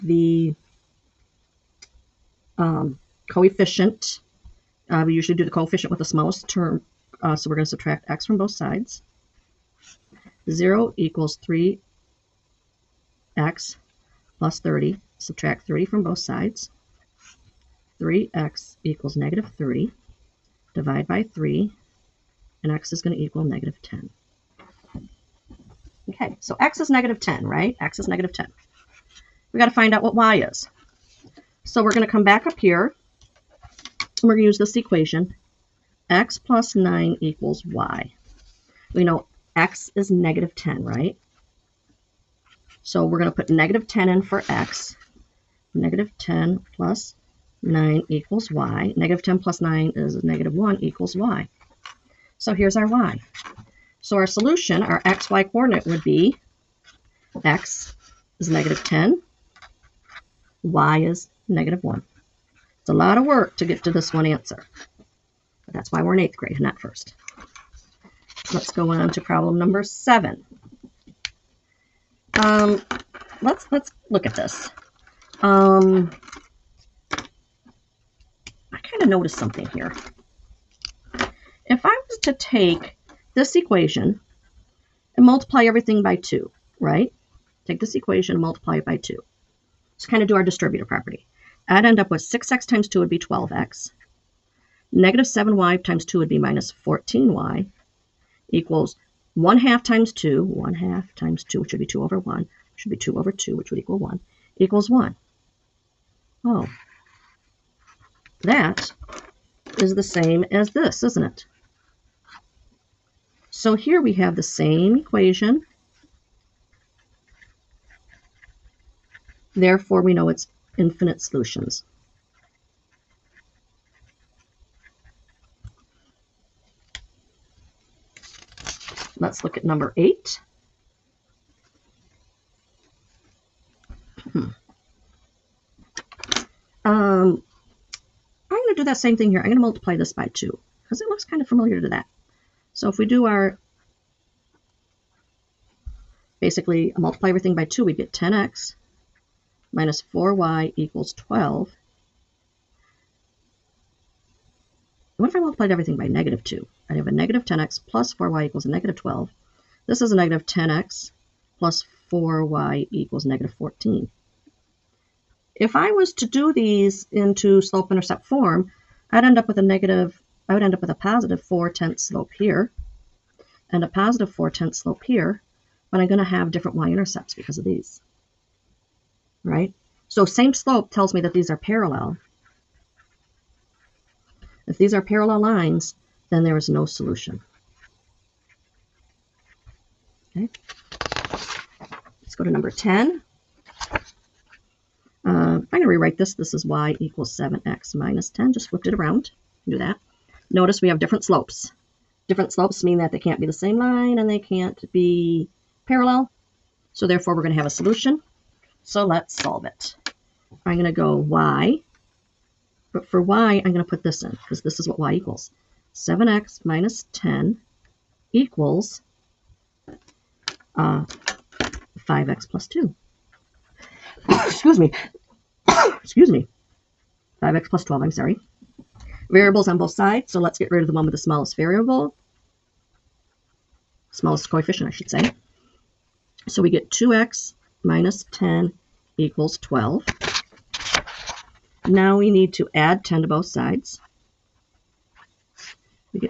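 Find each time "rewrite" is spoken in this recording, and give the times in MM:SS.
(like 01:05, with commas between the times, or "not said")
03:15.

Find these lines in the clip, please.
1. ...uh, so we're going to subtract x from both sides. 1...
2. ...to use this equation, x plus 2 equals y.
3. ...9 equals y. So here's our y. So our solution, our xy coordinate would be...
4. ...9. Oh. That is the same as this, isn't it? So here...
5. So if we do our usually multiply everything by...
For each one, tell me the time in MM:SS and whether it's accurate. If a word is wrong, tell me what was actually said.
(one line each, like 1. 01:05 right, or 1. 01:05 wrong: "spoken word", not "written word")
1. 00:07 wrong: "0", not "1"
2. 00:34 wrong: "9", not "2"
3. 00:50 wrong: "1", not "9"
4. 01:44 wrong: "1", not "9"
5. 02:22 wrong: "basically", not "usually".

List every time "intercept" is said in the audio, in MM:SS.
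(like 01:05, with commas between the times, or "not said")
02:47, 02:56.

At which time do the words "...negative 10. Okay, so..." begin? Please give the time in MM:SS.
00:23.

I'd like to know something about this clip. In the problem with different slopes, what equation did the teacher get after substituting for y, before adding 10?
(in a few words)
2x - 10 = 12.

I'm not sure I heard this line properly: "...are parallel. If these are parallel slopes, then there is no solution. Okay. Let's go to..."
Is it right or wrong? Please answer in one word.
wrong.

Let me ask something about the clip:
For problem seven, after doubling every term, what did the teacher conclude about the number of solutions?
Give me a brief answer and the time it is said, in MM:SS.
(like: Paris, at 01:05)
infinite solutions, at 02:00.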